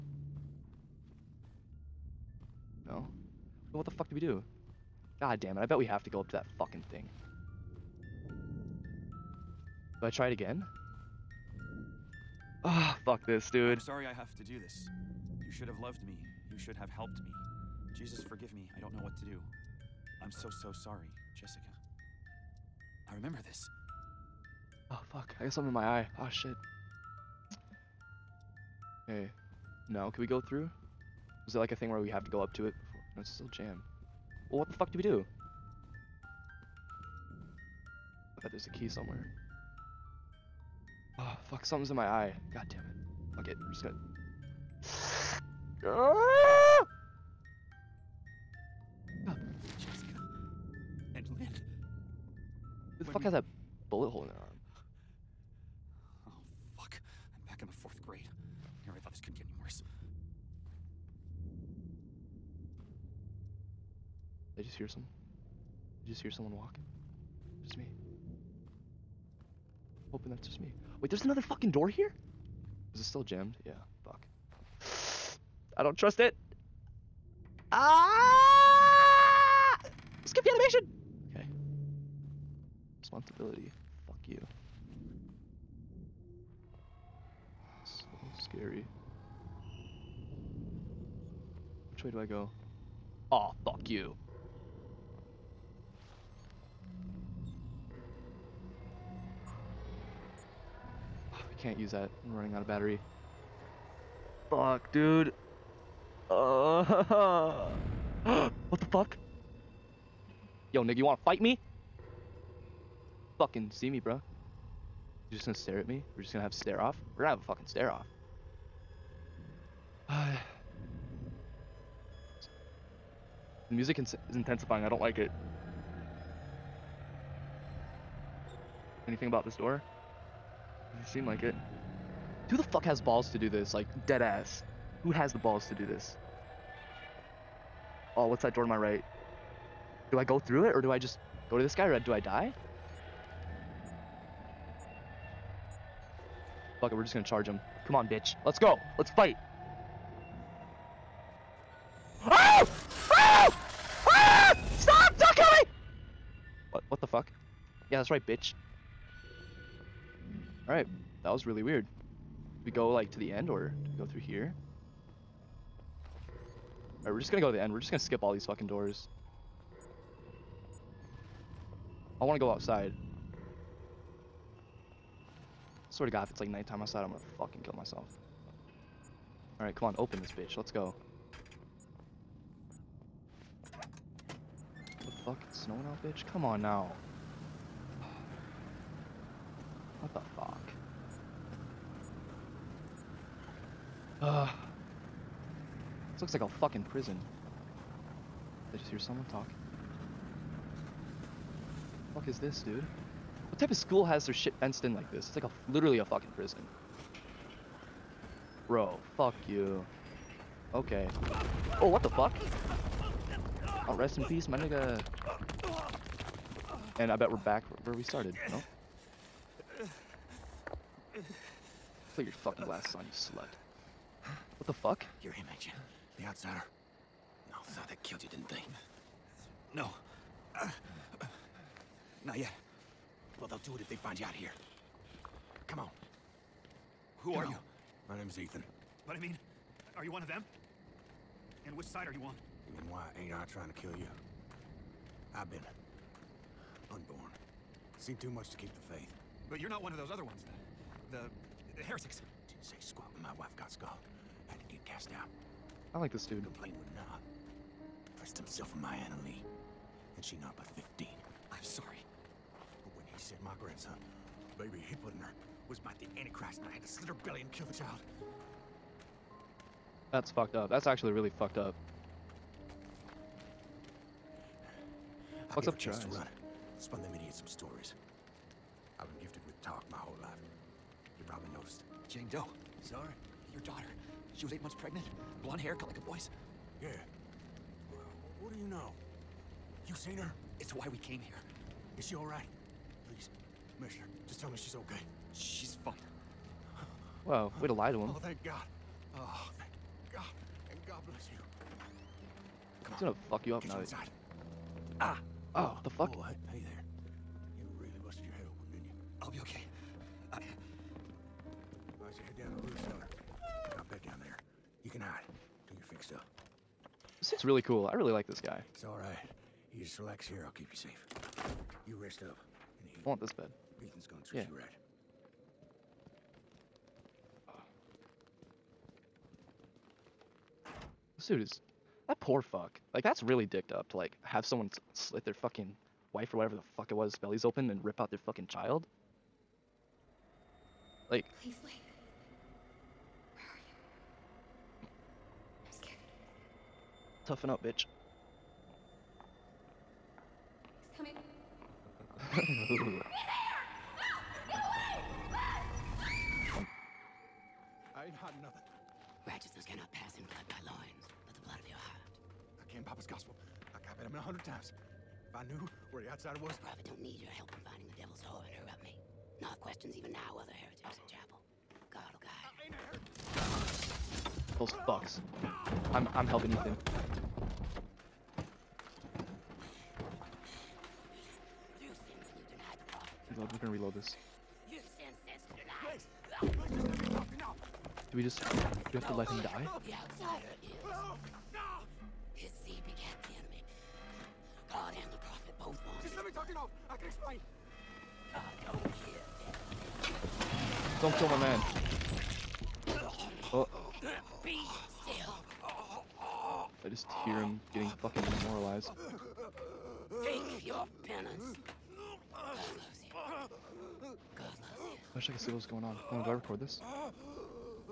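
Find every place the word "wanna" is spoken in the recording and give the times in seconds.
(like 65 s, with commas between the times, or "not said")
111 s, 172 s.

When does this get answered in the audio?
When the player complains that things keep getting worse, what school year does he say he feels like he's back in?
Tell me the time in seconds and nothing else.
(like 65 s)
57 s.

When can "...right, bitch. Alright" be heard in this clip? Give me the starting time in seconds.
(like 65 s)
158 s.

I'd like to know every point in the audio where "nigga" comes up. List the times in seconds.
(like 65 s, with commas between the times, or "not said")
110 s, 214 s.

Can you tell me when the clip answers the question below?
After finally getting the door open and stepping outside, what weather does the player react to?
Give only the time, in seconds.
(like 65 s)
185 s.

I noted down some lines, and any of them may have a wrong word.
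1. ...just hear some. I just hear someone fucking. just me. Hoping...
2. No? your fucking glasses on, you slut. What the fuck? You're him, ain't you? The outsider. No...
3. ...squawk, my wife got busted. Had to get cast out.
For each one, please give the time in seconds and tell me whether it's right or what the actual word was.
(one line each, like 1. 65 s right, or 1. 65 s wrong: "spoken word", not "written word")
1. 64 s wrong: "walking", not "fucking"
2. 218 s right
3. 252 s wrong: "scalded", not "busted".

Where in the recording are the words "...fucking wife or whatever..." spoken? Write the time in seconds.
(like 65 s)
335 s.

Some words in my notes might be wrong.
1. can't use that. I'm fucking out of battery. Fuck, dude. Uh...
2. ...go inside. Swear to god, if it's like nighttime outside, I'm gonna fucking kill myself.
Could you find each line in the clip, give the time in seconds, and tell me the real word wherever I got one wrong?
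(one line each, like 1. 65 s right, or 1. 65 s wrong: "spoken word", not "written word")
1. 101 s wrong: "running", not "fucking"
2. 172 s wrong: "outside", not "inside".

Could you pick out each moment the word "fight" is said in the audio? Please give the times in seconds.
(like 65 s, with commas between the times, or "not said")
111 s, 149 s.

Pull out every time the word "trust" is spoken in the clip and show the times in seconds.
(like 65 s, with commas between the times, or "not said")
75 s.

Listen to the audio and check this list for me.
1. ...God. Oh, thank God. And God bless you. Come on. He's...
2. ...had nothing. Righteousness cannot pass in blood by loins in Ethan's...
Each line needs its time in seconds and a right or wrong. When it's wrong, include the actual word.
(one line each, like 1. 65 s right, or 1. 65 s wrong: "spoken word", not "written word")
1. 298 s right
2. 358 s wrong: "Papa", not "Ethan".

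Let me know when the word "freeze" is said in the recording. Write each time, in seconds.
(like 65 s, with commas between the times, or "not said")
not said.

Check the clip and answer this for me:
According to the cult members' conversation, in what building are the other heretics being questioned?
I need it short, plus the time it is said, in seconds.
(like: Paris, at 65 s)
chapel, at 371 s.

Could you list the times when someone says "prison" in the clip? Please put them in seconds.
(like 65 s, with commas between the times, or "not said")
196 s, 206 s.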